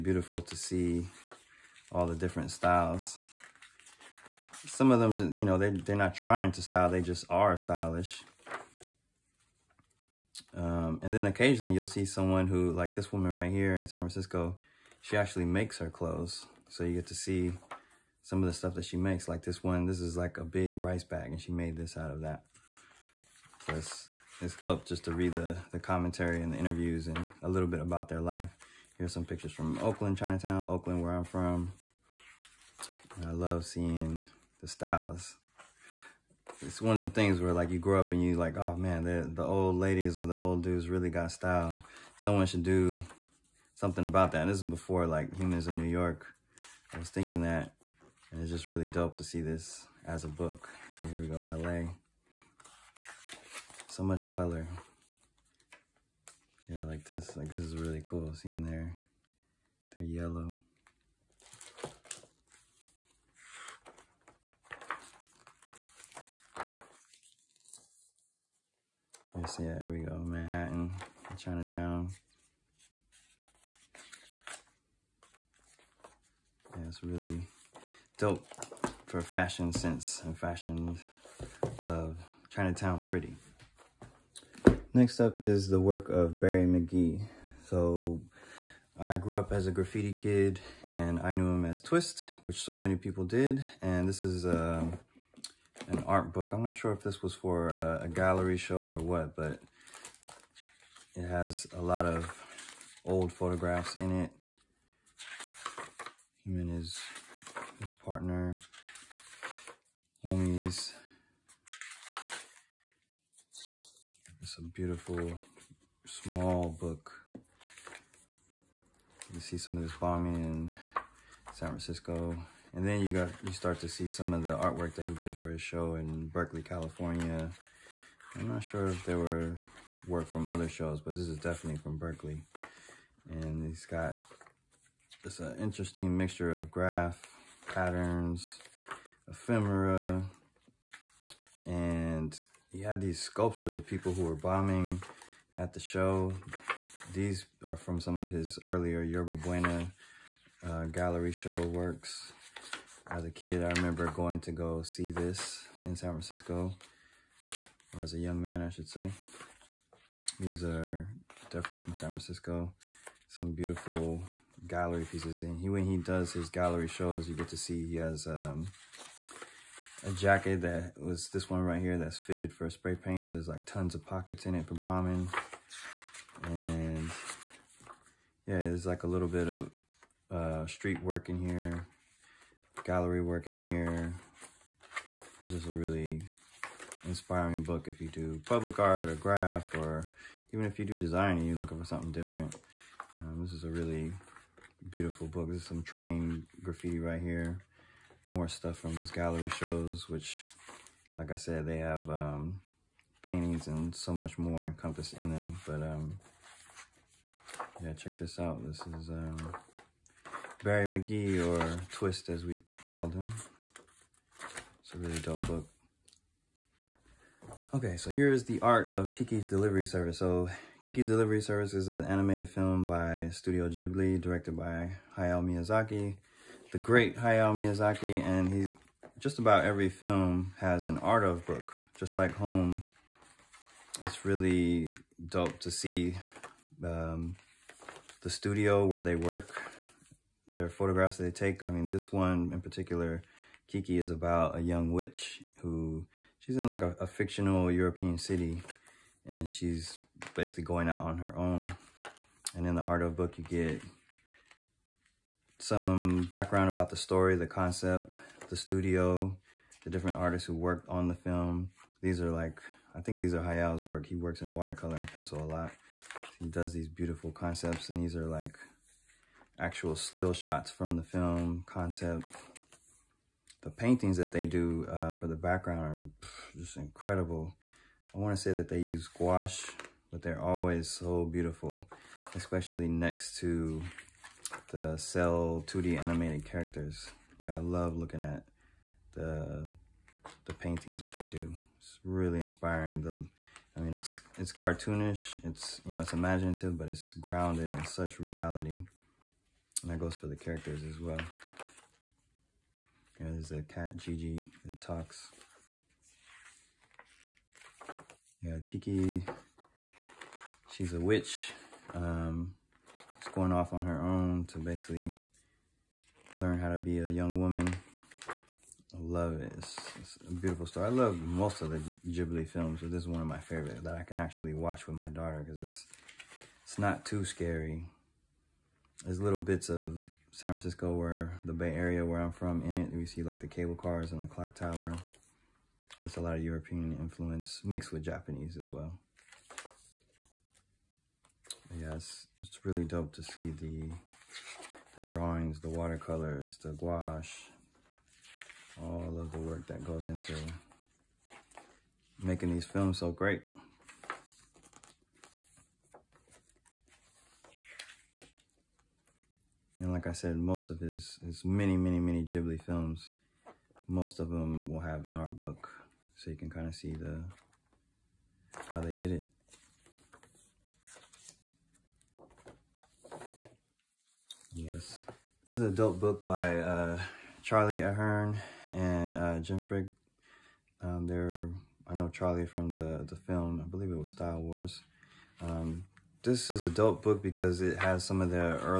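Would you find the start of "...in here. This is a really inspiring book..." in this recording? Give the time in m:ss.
3:03.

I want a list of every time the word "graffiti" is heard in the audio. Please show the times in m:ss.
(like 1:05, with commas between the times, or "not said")
1:29, 3:16.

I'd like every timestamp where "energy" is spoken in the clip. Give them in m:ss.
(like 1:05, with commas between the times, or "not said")
not said.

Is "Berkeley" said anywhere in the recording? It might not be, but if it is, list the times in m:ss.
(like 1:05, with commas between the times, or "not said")
2:06, 2:11.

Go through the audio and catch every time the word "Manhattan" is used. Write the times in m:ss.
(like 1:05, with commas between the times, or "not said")
1:10.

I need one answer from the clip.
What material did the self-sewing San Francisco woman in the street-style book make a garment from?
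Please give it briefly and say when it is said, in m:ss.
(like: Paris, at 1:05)
rice bag, at 0:20.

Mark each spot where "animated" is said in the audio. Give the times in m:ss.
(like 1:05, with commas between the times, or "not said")
3:42, 4:46.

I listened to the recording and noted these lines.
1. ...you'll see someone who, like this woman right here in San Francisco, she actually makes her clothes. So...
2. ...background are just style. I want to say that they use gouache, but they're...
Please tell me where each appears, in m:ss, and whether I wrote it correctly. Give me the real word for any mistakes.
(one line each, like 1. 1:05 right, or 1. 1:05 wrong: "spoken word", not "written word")
1. 0:11 right
2. 4:35 wrong: "incredible", not "style".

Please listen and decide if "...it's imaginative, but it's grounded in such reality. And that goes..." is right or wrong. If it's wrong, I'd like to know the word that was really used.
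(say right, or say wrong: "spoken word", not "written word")
right.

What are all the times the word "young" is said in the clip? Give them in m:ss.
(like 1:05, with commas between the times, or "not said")
2:38, 4:04, 5:17.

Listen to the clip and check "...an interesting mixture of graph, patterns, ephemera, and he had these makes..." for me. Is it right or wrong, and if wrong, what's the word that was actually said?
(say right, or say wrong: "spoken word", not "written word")
wrong: "sculptures", not "makes".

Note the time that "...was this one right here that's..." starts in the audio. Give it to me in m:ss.
2:50.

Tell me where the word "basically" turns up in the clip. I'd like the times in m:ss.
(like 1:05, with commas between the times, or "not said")
4:10, 5:14.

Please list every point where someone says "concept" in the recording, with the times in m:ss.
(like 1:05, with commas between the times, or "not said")
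4:17, 4:27, 4:31.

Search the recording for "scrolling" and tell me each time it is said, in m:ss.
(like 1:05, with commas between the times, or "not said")
not said.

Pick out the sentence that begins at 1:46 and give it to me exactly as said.
Him and his, his partner, homies.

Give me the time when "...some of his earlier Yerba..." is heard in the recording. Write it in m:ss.
2:28.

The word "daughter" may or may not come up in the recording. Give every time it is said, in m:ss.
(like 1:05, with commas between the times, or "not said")
5:25.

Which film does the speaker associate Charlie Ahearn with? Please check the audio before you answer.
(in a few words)
Style Wars.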